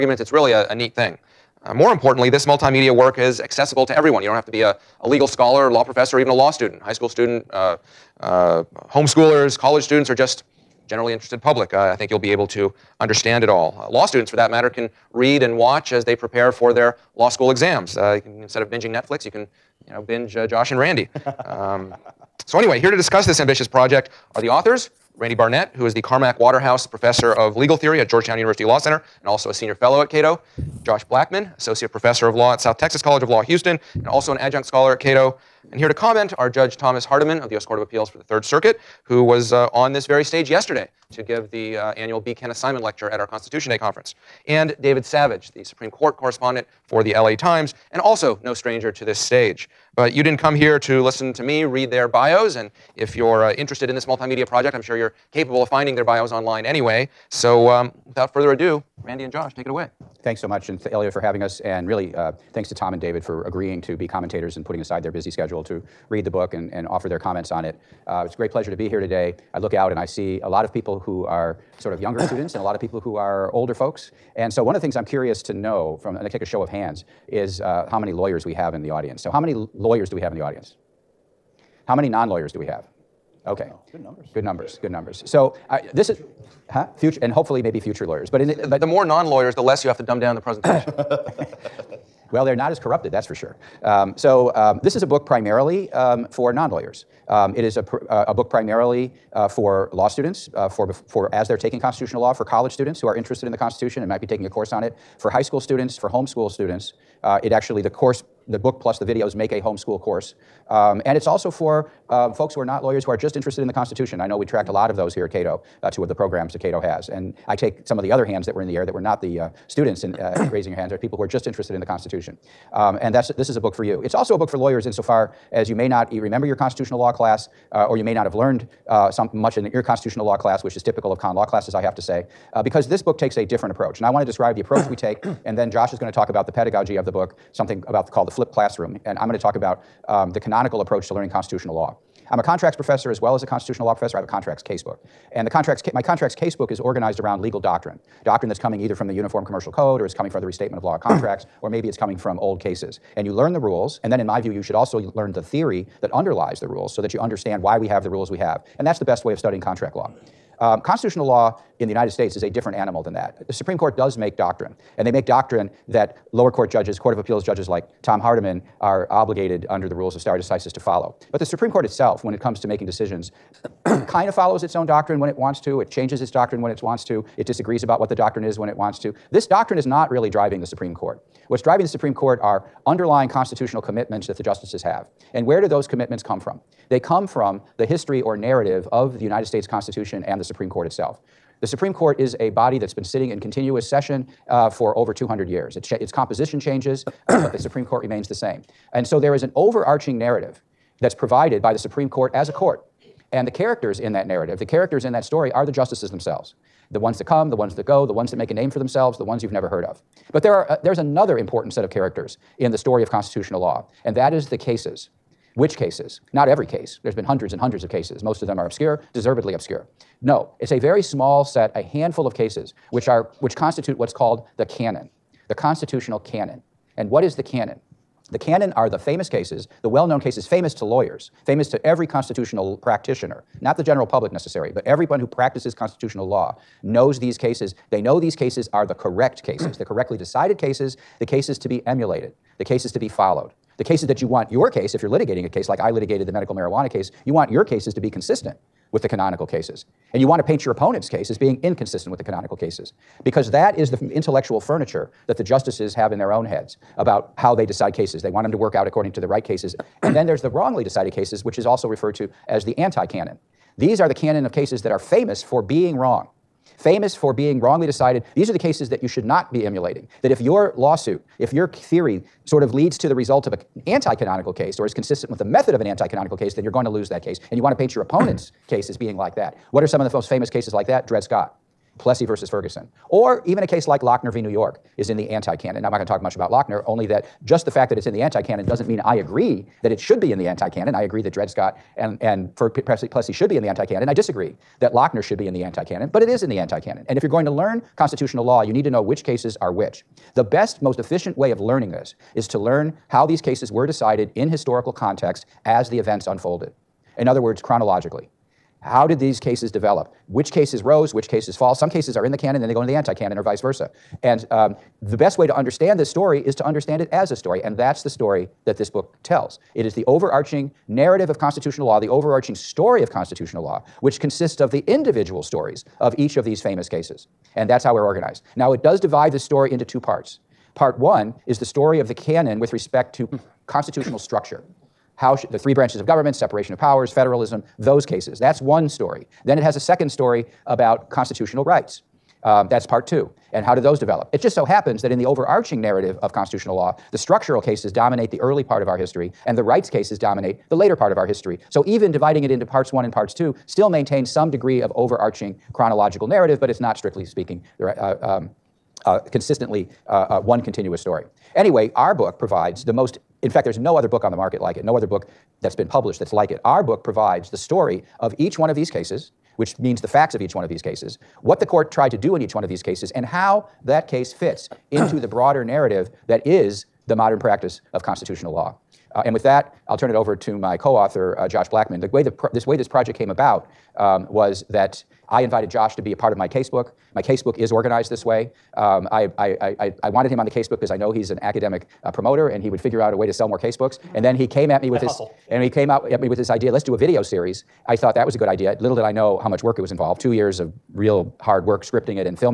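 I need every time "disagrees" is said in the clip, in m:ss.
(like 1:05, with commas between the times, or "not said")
2:57, 4:54.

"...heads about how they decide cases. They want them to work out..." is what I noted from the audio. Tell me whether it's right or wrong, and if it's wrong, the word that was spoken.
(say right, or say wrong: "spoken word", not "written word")
right.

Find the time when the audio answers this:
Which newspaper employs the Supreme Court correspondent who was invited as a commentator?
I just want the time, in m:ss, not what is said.
0:47.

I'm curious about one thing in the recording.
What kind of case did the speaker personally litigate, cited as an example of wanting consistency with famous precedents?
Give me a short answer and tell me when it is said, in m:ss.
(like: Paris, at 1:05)
Medical marijuana case, at 4:06.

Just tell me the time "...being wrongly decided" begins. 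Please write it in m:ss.
4:27.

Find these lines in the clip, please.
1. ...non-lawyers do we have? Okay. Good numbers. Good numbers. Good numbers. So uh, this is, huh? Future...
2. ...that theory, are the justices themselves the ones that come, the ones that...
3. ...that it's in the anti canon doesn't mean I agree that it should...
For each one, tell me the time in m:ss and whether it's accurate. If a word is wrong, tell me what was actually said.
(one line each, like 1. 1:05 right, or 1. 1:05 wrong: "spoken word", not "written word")
1. 1:22 right
2. 3:25 wrong: "story", not "theory"
3. 4:47 right.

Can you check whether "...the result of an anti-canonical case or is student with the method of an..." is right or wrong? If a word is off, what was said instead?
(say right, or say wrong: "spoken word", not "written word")
wrong: "consistent", not "student".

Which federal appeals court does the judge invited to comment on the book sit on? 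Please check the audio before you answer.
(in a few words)
Third Circuit.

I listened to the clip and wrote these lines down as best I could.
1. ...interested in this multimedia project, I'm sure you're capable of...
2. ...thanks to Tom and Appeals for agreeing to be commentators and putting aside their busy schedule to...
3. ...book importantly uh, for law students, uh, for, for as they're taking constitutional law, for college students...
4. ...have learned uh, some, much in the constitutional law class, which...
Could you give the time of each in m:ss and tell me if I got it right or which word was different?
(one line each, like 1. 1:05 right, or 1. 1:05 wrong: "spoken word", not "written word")
1. 0:53 right
2. 1:02 wrong: "David", not "Appeals"
3. 1:38 wrong: "primarily", not "importantly"
4. 2:08 right.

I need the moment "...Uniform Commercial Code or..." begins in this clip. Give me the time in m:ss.
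2:29.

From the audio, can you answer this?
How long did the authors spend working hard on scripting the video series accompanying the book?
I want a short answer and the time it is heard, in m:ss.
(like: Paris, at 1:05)
2 years, at 6:40.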